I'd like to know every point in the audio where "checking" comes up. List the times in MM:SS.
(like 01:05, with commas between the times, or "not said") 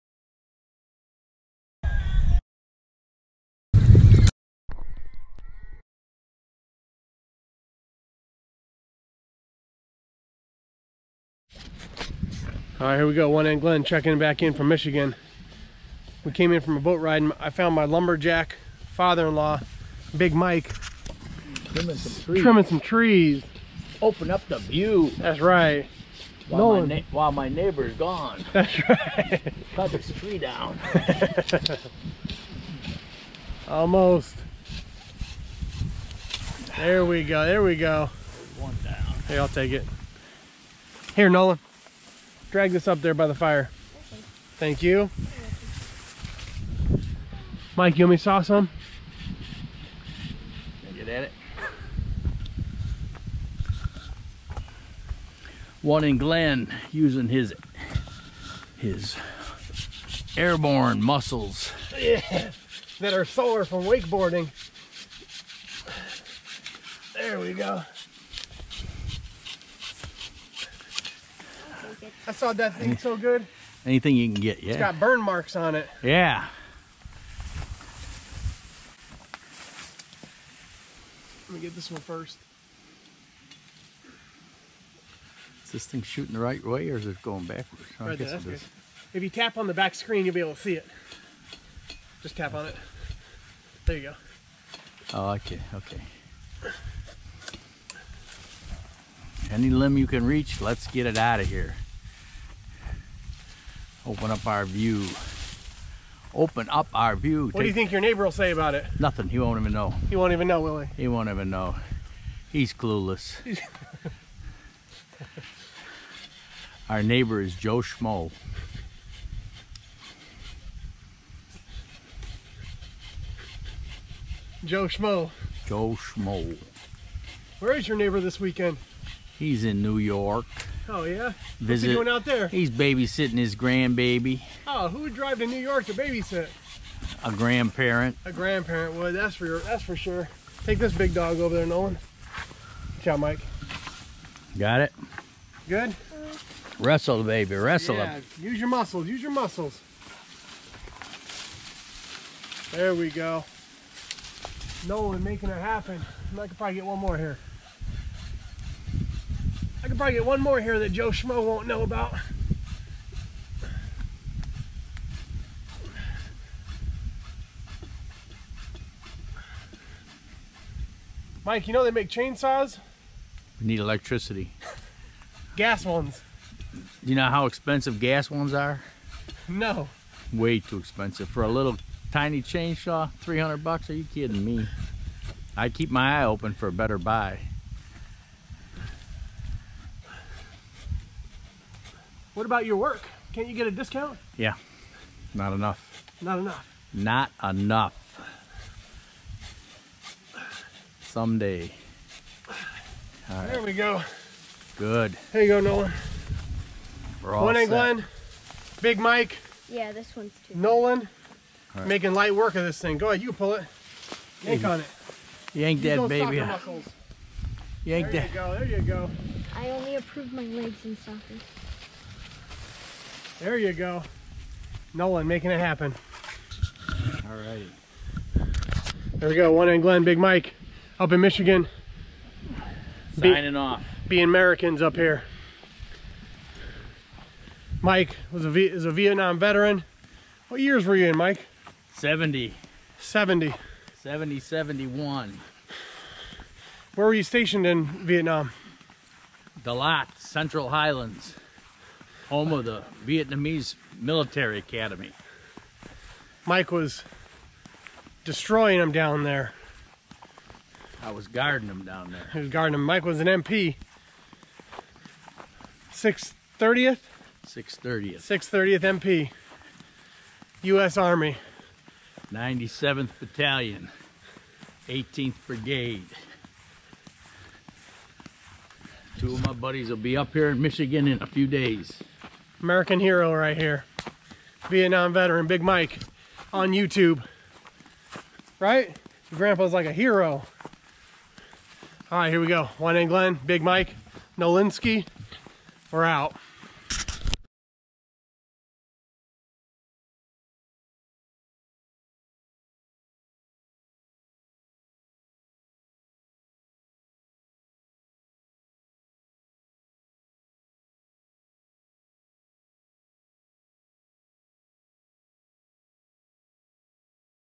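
00:13.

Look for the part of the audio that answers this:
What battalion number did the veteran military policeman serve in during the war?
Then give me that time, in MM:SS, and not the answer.
04:32.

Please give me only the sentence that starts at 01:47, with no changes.
What Take do you think your neighbor will say about it?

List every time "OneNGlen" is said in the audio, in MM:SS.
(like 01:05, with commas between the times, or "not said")
00:13, 00:55, 03:49, 04:52.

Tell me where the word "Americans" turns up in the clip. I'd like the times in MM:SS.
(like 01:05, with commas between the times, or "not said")
03:54, 04:42.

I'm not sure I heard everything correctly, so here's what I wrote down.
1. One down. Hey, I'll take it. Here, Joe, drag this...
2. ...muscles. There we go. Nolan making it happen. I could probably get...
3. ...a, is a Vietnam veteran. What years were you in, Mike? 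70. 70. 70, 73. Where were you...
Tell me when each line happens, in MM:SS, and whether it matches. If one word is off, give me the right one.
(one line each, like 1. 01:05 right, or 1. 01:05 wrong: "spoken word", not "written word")
1. 00:38 wrong: "Nola", not "Joe"
2. 02:29 right
3. 03:58 wrong: "71", not "73".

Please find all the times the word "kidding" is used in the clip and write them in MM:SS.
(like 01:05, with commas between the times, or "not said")
03:04.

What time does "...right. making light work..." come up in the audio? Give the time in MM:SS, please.
03:31.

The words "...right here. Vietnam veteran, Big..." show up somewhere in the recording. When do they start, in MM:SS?
04:43.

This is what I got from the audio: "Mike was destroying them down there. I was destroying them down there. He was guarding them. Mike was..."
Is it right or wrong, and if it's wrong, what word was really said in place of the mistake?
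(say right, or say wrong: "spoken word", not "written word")
wrong: "guarding", not "destroying".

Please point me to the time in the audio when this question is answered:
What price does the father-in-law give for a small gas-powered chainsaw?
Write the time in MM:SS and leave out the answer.
03:03.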